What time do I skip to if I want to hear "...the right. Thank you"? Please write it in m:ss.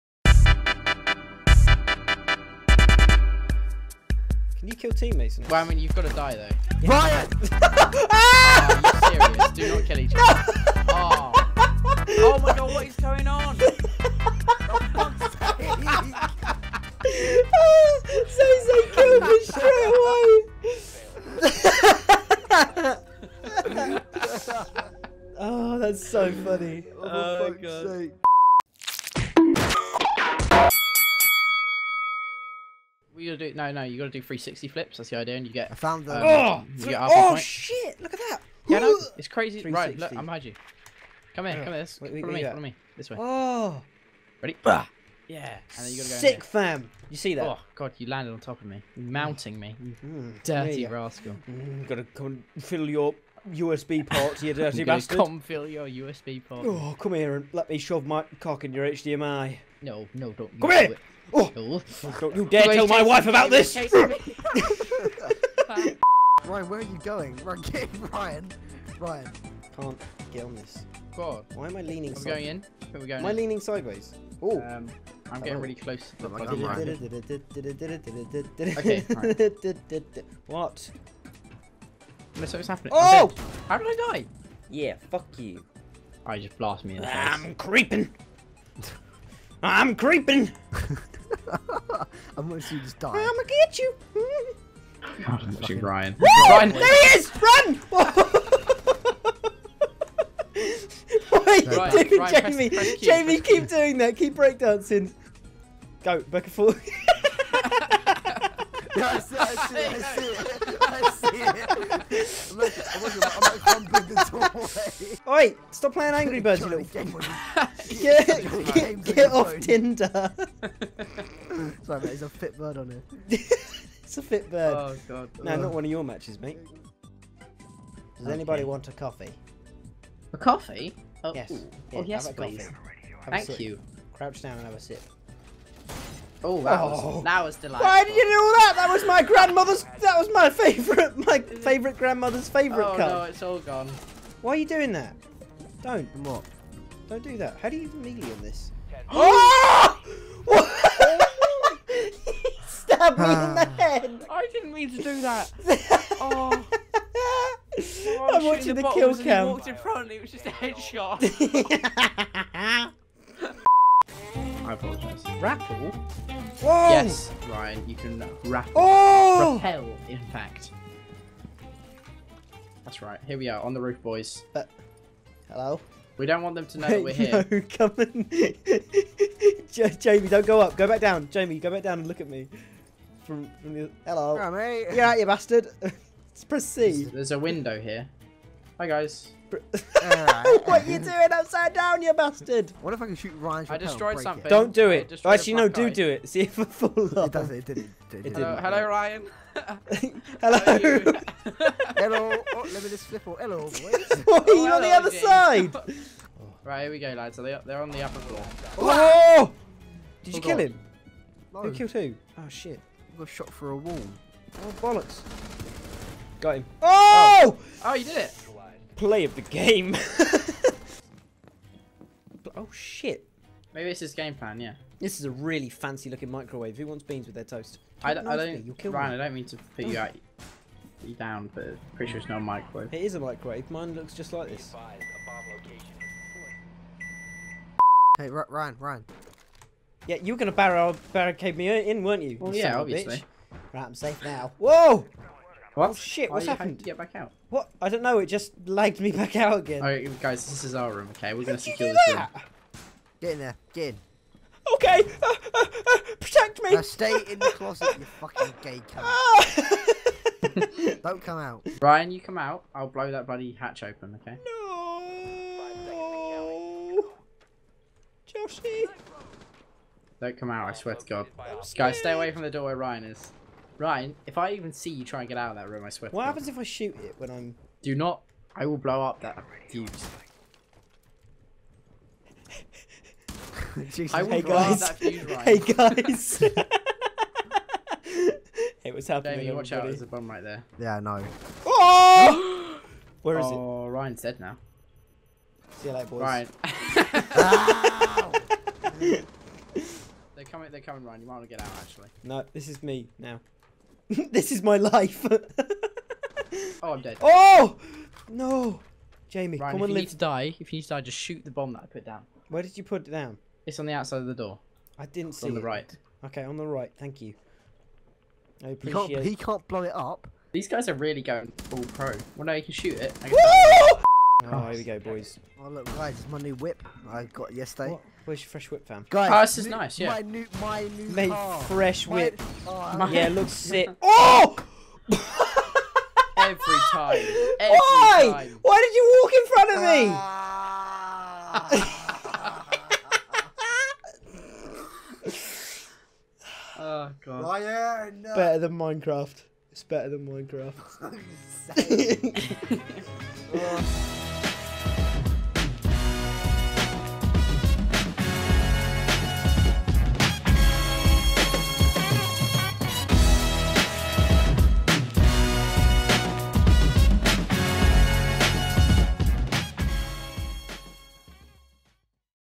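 5:16.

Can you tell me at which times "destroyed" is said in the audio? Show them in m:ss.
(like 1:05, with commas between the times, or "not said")
3:13.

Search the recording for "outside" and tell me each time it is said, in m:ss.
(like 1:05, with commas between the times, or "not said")
5:13.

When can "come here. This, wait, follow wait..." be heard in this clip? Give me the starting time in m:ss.
0:41.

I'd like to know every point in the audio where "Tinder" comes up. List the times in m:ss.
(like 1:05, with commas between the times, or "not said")
1:59.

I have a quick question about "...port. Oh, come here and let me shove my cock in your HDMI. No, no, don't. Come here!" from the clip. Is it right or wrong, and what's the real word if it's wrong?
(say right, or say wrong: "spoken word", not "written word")
right.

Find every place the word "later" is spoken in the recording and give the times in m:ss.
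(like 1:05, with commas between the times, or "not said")
4:55.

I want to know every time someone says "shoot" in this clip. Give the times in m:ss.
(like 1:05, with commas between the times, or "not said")
3:13, 4:36, 5:11, 5:22.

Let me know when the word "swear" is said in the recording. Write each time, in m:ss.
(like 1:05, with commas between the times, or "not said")
4:30, 4:35.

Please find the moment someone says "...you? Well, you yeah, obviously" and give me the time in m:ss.
4:02.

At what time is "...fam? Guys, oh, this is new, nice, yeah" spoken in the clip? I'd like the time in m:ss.
5:28.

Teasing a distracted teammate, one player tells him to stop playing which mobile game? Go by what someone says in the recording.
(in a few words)
Angry Birds.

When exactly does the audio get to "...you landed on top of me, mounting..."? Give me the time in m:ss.
0:47.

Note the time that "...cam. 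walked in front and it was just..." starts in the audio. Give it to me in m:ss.
2:39.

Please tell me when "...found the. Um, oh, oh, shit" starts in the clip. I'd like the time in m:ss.
0:35.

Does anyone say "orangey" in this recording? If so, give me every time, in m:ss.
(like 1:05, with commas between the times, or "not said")
not said.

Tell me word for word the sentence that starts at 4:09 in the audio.
Alright, guys, this is our room, okay?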